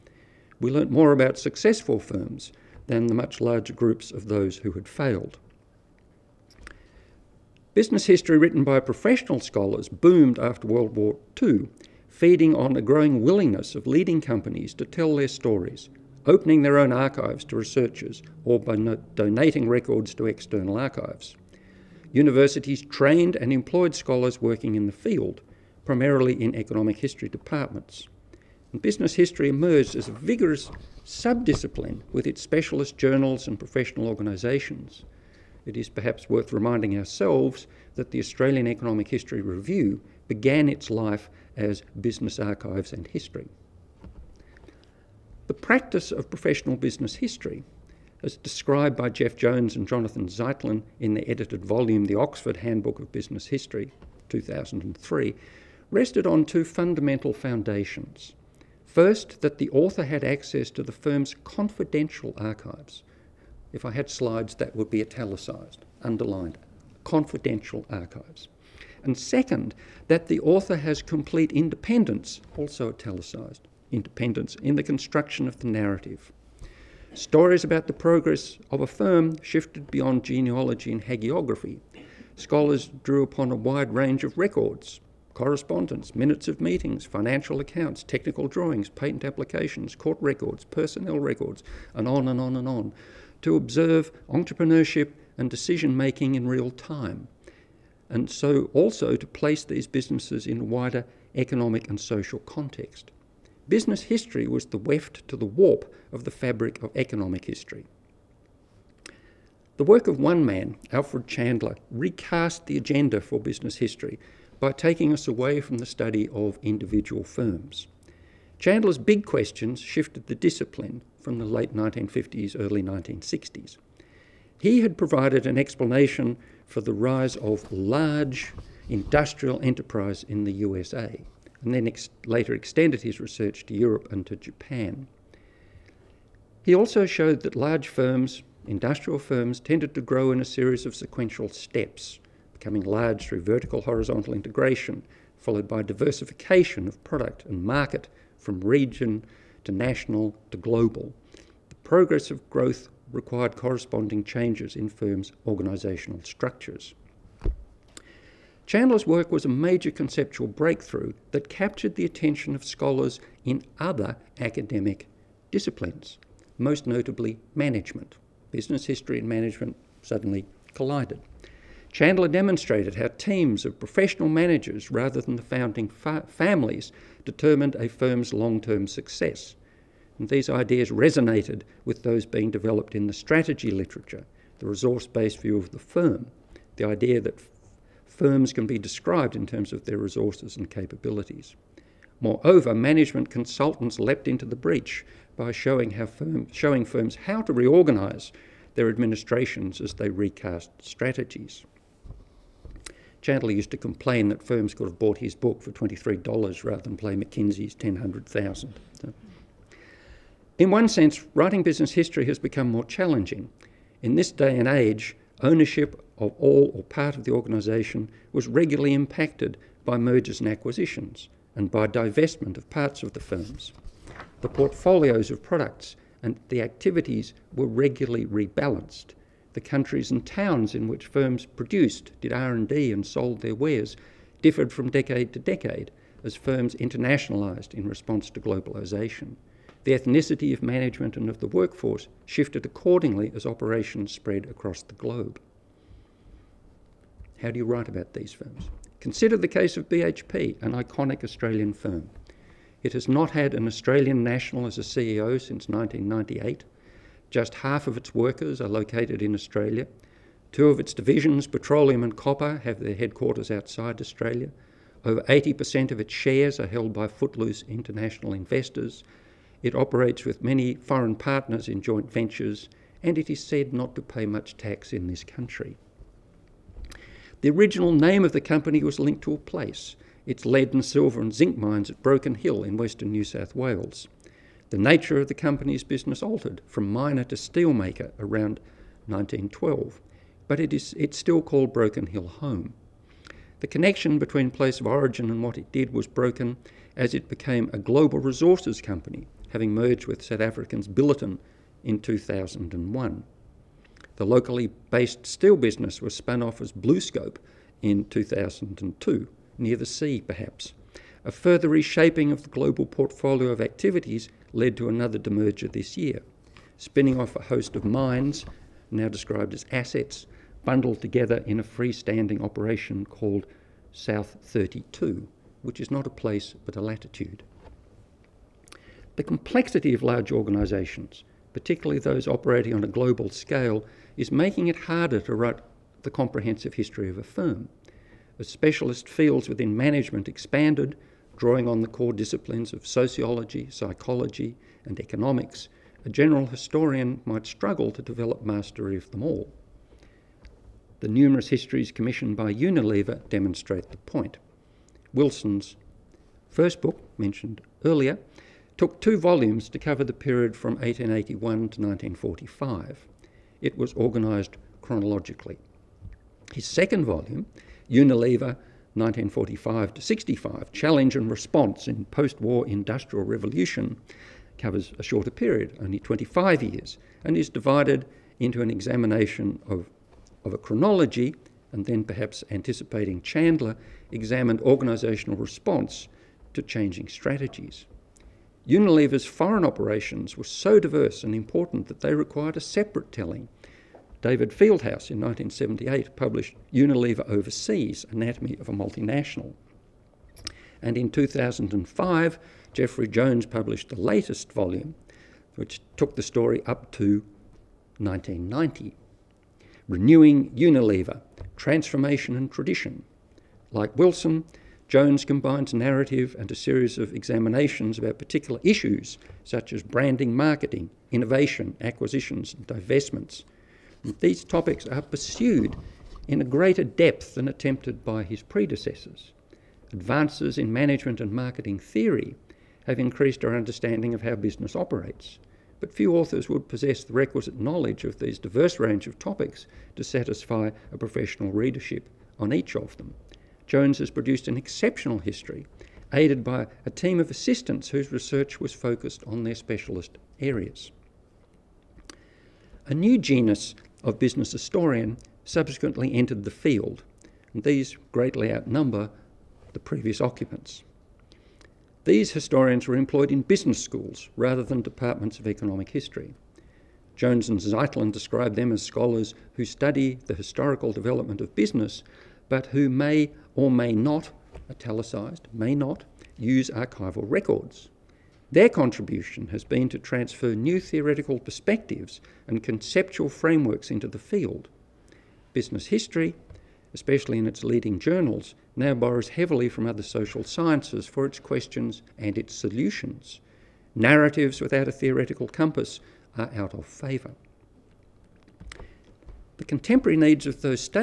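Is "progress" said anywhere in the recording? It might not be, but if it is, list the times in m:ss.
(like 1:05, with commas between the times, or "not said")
1:17, 2:31.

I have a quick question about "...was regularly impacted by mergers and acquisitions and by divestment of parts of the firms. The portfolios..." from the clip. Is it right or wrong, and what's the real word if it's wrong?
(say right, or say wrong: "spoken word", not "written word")
right.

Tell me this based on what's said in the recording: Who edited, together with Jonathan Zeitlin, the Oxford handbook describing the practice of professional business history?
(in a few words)
Jeff Jones.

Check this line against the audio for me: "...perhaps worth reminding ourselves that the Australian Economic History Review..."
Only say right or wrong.
right.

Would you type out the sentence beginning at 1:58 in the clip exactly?
Chandler's big questions shifted the discipline from the late 1950s, early 1960s.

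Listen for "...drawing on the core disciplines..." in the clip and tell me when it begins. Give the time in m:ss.
5:41.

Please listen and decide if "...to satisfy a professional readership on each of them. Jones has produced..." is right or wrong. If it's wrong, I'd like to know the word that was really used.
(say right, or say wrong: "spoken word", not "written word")
right.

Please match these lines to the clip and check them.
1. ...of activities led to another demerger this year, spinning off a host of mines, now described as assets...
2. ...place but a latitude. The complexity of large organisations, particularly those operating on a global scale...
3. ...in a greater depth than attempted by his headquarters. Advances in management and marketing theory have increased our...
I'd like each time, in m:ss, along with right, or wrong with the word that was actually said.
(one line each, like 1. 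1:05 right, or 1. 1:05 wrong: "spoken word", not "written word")
1. 5:13 right
2. 5:26 right
3. 7:06 wrong: "predecessors", not "headquarters".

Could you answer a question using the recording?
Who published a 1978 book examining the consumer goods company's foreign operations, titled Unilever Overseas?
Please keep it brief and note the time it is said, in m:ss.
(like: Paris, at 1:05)
David Fieldhouse, at 6:34.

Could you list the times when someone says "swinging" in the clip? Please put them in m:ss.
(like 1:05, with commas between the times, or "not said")
not said.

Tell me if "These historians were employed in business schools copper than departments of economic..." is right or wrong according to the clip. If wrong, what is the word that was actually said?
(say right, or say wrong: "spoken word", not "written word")
wrong: "rather", not "copper".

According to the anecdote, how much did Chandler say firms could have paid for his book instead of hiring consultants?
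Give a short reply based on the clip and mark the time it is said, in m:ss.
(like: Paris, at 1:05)
$23, at 3:25.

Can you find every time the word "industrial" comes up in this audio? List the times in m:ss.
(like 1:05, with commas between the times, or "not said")
2:08, 2:18, 6:12.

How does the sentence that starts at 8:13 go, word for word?
Narratives without a theoretical compass are out of favour.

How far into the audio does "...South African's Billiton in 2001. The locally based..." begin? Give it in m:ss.
5:00.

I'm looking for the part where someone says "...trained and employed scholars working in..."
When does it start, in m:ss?
0:22.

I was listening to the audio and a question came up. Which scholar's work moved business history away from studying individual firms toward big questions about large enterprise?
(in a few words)
Alfred Chandler.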